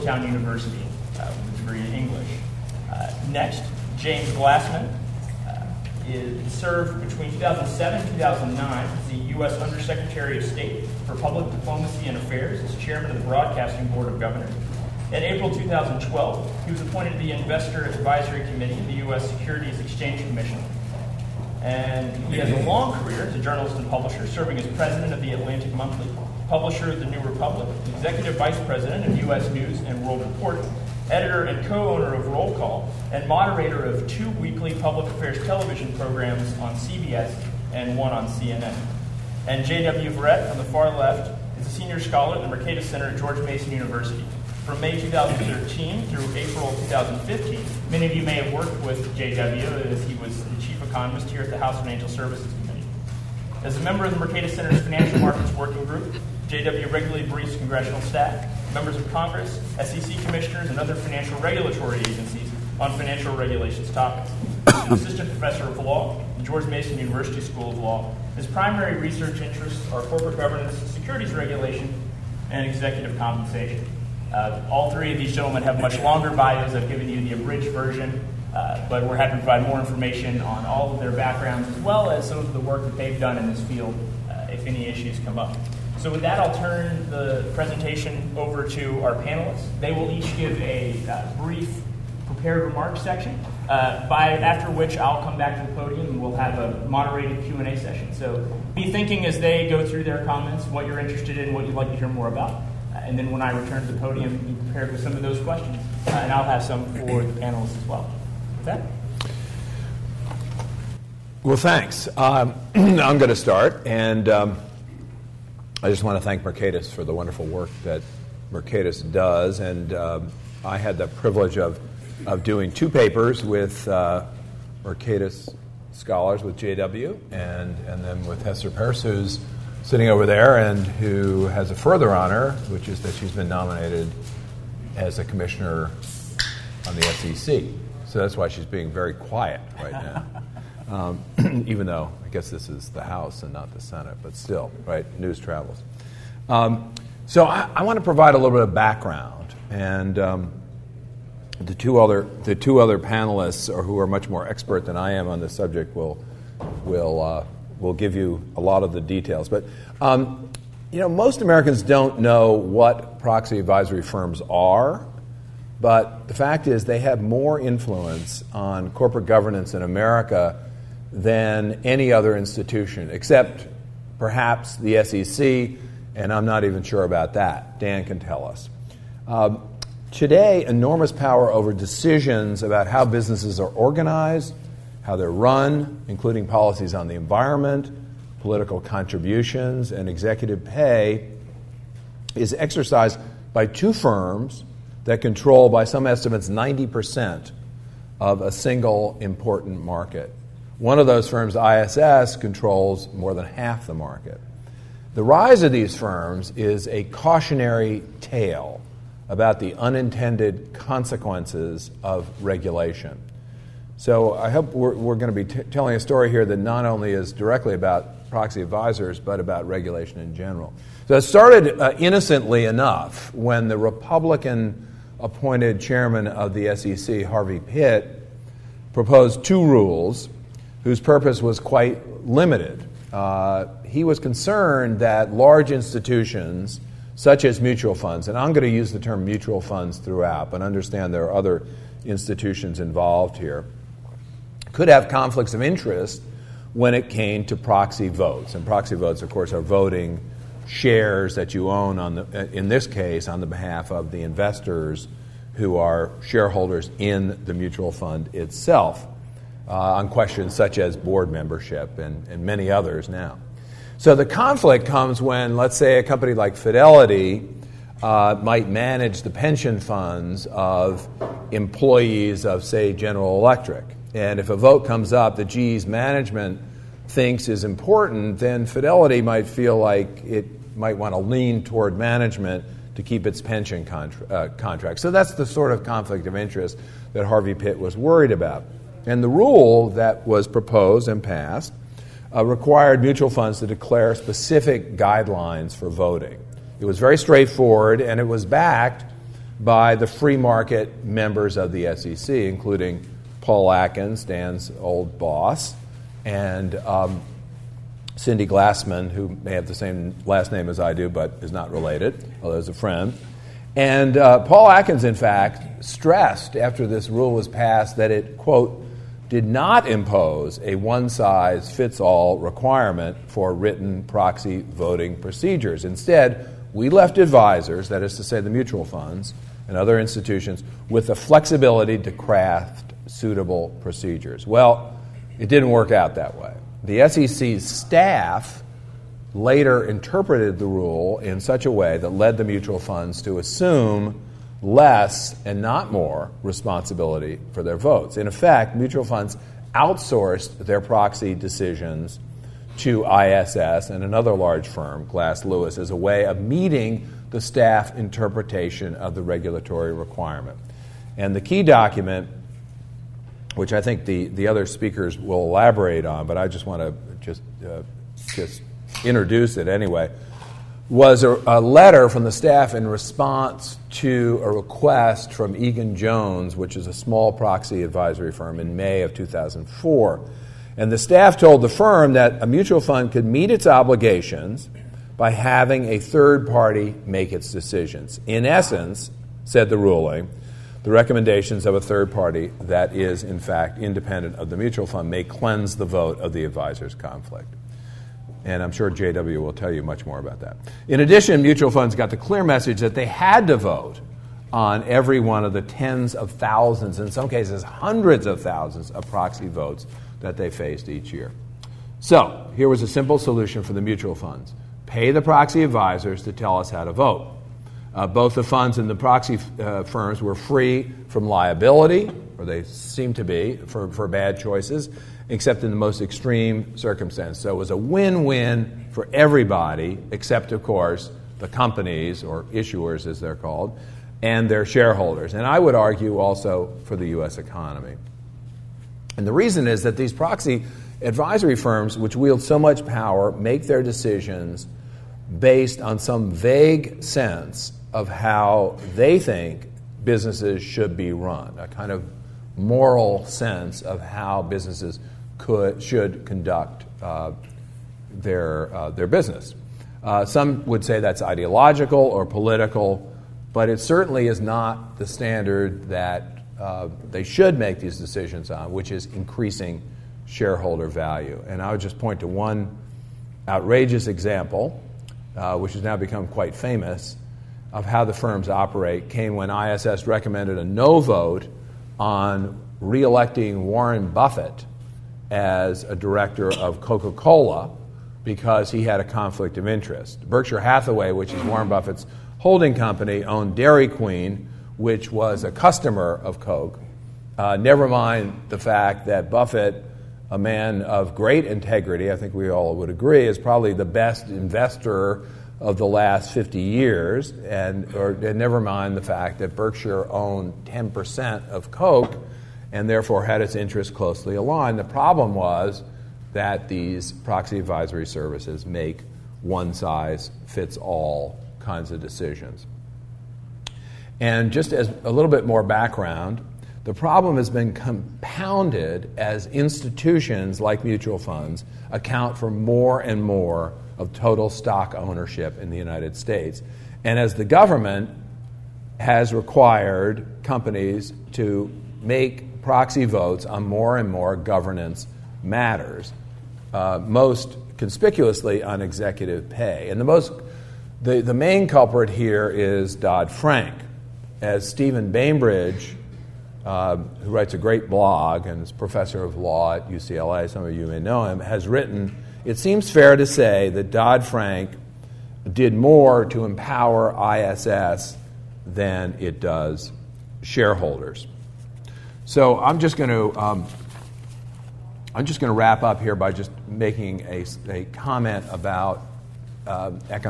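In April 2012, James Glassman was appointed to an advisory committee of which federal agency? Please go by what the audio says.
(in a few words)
U.S. Securities Exchange Commission.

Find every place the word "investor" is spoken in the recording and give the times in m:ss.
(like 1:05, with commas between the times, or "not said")
0:17, 4:14, 8:24.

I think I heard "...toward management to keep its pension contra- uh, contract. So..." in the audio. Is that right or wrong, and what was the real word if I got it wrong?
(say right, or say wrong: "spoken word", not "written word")
right.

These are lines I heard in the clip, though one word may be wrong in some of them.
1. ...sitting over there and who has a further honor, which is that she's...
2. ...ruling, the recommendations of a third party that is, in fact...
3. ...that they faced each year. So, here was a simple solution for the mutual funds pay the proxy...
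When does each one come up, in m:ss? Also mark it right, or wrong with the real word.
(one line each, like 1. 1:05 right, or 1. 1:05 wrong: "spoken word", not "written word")
1. 2:09 right
2. 6:29 right
3. 6:50 right.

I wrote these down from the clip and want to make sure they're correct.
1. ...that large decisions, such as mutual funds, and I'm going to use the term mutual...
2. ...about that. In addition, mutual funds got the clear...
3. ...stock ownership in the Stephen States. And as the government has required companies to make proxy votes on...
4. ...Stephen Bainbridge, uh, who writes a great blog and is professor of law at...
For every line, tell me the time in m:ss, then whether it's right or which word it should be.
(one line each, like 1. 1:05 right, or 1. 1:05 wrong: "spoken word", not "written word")
1. 3:54 wrong: "institutions", not "decisions"
2. 6:40 right
3. 8:54 wrong: "United", not "Stephen"
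4. 9:14 right.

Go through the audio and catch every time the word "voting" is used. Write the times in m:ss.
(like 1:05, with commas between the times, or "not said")
4:09, 4:55, 5:24.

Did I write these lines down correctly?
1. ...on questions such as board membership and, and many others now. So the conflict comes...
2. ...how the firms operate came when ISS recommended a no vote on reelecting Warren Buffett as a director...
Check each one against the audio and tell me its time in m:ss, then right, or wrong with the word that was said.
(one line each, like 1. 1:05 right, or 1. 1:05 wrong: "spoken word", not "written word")
1. 4:19 right
2. 7:57 right.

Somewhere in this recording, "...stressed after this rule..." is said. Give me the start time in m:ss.
5:15.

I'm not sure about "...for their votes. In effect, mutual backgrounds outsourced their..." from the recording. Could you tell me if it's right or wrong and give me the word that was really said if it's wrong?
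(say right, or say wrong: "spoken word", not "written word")
wrong: "funds", not "backgrounds".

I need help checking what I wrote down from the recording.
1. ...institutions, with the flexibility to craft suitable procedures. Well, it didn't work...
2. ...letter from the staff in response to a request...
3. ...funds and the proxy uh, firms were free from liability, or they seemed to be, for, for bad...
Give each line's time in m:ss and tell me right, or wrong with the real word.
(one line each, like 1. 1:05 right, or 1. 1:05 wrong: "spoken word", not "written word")
1. 5:29 right
2. 6:11 right
3. 6:58 right.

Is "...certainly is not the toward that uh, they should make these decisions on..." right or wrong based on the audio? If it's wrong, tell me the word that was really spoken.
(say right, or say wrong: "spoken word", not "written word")
wrong: "standard", not "toward".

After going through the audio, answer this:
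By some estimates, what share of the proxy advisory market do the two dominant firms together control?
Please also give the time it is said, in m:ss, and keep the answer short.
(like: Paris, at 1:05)
90%, at 3:16.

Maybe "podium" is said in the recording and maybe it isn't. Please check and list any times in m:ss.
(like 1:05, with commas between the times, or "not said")
1:35, 1:43.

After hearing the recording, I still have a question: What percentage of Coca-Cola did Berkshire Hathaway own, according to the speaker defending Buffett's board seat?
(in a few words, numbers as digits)
10%.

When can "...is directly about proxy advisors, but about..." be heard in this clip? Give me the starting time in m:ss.
3:37.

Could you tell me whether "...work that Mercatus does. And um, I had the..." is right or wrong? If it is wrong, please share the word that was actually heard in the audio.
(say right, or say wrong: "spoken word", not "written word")
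right.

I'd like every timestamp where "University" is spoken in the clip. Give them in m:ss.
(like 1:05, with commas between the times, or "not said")
0:00, 0:43, 1:06.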